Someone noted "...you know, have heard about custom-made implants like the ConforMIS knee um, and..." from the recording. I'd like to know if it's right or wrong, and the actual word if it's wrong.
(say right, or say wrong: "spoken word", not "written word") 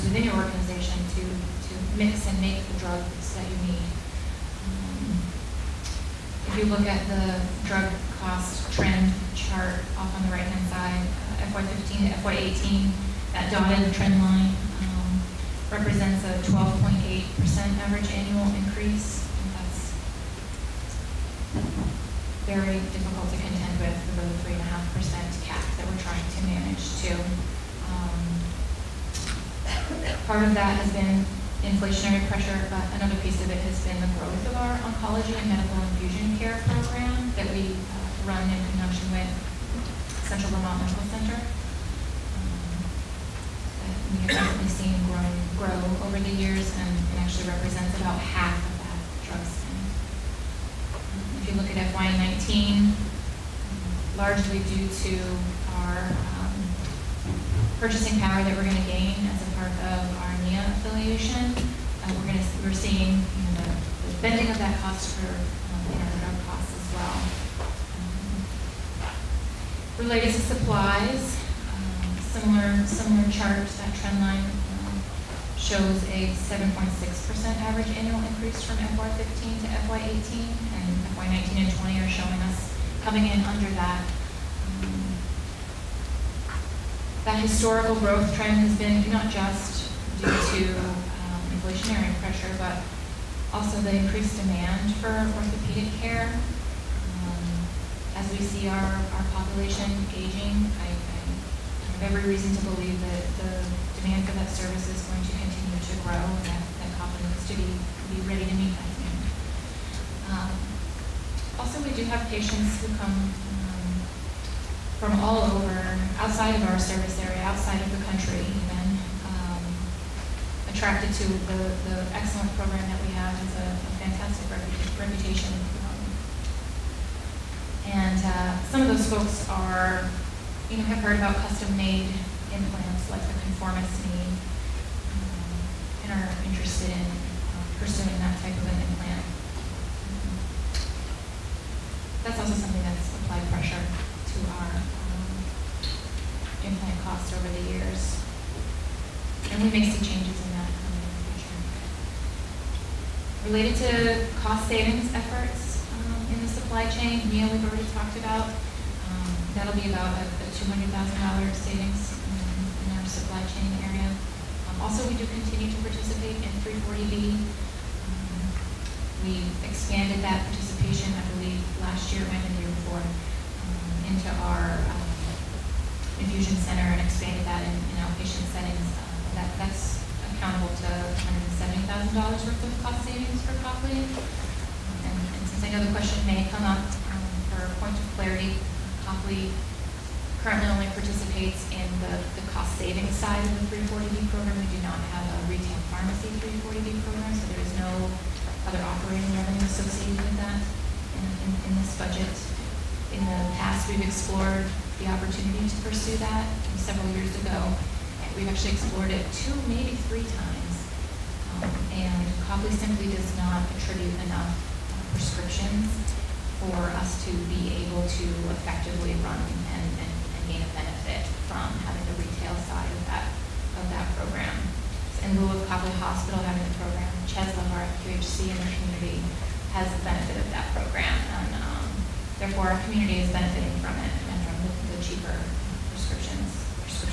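right.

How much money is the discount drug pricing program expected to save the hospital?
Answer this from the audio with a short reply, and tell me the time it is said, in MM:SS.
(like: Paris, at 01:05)
$170,000, at 03:01.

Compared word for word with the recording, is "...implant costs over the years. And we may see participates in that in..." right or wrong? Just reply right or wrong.
wrong.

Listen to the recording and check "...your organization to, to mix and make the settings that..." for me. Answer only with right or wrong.
wrong.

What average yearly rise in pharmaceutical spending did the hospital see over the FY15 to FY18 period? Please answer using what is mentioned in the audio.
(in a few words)
12.8%.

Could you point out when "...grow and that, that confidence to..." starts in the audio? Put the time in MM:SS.
01:46.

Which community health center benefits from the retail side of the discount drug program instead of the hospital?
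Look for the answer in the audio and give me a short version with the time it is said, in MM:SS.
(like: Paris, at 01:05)
Cheslin, at 03:47.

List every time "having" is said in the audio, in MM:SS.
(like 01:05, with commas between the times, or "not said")
03:41, 03:46.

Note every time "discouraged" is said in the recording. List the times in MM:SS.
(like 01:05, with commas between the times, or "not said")
not said.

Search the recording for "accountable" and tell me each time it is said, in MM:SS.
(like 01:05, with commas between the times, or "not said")
03:00.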